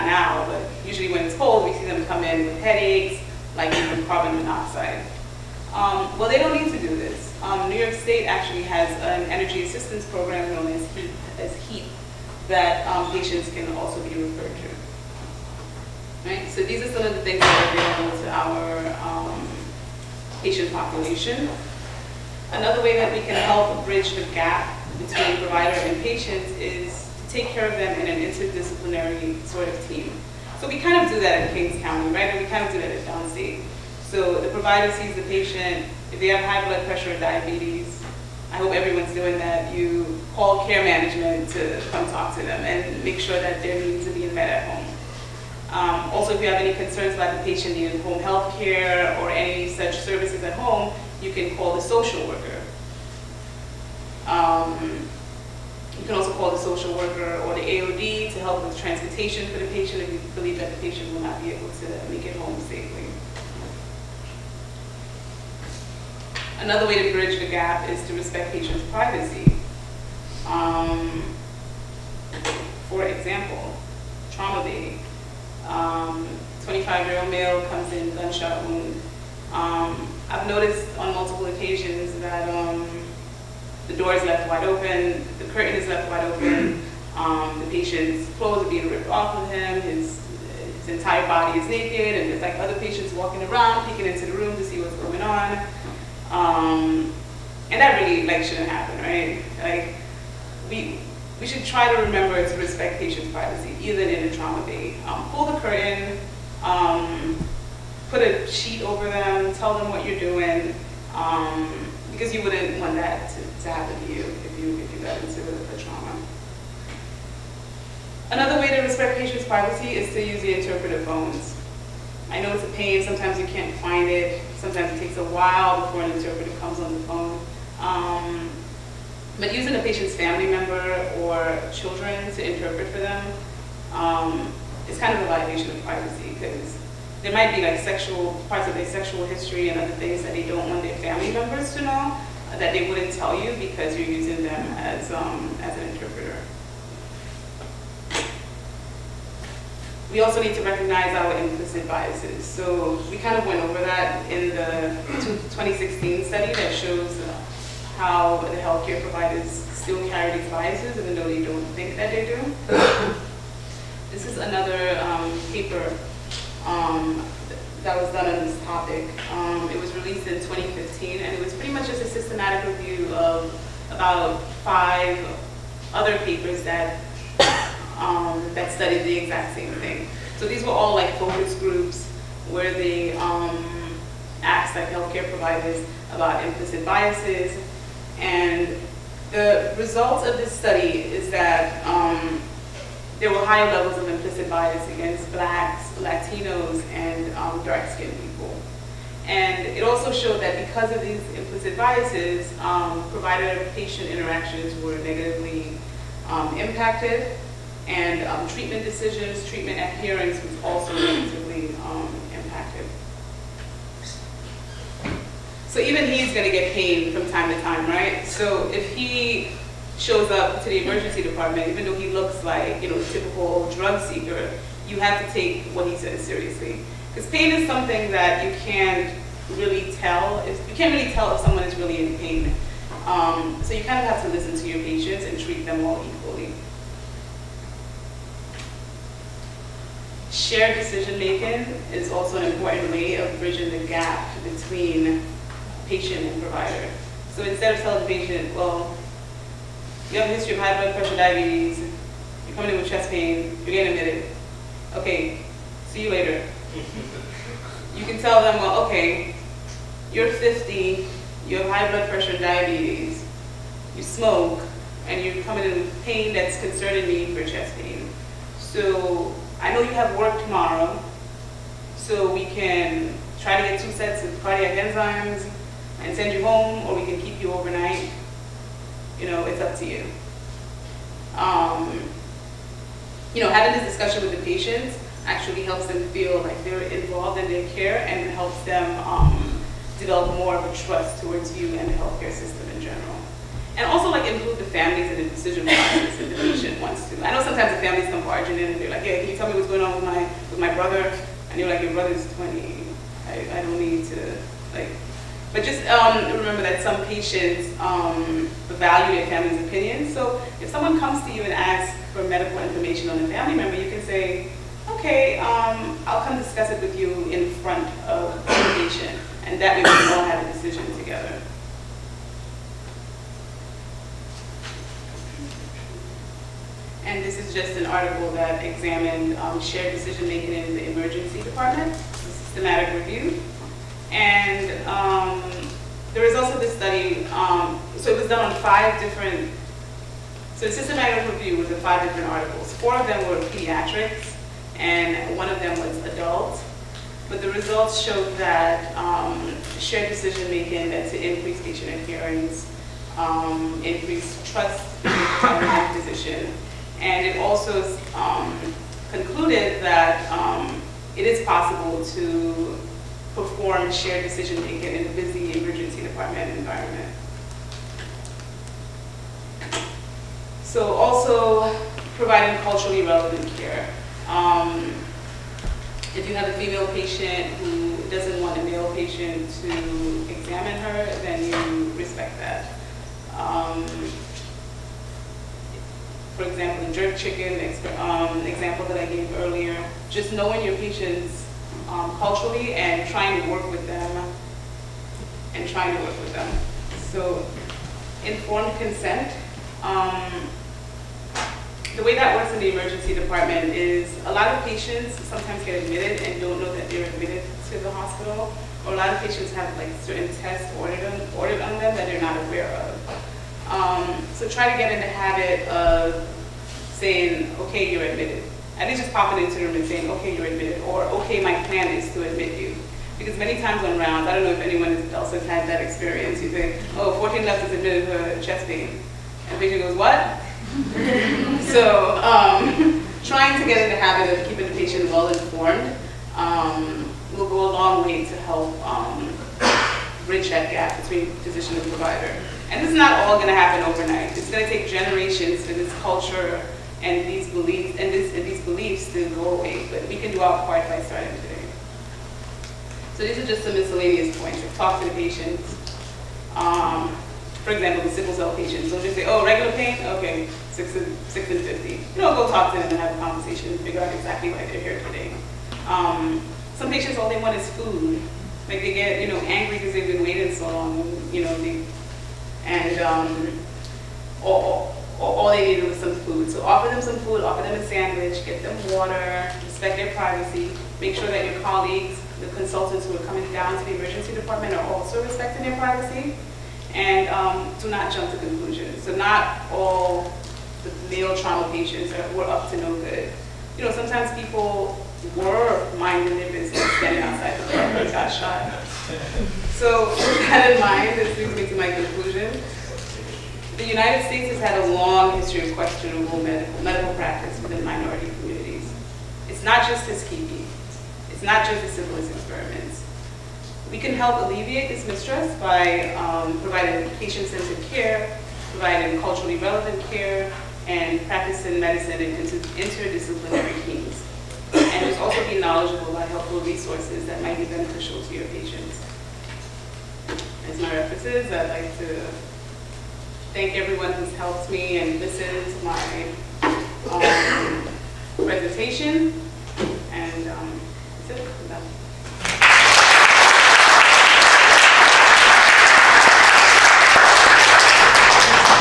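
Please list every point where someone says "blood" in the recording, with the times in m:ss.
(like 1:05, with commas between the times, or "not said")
0:36, 4:10, 4:21.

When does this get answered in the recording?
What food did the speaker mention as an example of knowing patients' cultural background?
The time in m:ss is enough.
6:26.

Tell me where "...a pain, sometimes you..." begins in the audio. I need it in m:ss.
2:02.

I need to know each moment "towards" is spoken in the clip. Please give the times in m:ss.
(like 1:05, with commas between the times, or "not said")
4:51.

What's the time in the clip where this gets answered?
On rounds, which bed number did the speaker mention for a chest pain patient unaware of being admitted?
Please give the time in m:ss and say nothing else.
7:07.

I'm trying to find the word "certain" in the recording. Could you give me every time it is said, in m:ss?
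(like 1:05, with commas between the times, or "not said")
6:50.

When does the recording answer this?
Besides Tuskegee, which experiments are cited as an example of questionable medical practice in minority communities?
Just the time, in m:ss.
8:31.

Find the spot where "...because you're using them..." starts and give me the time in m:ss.
2:23.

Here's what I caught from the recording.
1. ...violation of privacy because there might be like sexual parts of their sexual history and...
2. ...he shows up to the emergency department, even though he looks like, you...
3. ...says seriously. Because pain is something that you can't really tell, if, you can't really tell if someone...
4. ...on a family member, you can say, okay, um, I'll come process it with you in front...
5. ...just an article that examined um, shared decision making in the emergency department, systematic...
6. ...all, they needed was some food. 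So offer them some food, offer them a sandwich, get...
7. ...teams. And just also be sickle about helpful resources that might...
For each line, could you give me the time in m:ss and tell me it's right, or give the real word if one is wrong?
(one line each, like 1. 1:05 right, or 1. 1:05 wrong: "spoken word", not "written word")
1. 2:15 right
2. 3:38 right
3. 3:45 right
4. 5:13 wrong: "discuss", not "process"
5. 5:27 right
6. 7:55 right
7. 8:43 wrong: "knowledgeable", not "sickle".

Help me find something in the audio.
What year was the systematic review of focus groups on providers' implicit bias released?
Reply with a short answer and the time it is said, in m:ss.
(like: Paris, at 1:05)
2015, at 2:50.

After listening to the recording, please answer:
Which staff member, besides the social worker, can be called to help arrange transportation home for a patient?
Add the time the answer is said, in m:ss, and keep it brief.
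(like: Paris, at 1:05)
The AOD, at 0:57.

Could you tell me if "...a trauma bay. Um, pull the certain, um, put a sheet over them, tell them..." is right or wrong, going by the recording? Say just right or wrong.
wrong.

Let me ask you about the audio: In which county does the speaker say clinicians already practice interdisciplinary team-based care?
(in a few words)
Kings County.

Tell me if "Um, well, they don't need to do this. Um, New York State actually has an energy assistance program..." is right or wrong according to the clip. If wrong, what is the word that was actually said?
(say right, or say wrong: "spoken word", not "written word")
right.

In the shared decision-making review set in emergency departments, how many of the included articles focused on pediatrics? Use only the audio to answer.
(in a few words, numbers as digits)
4.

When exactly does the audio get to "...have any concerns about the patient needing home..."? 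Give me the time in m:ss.
0:46.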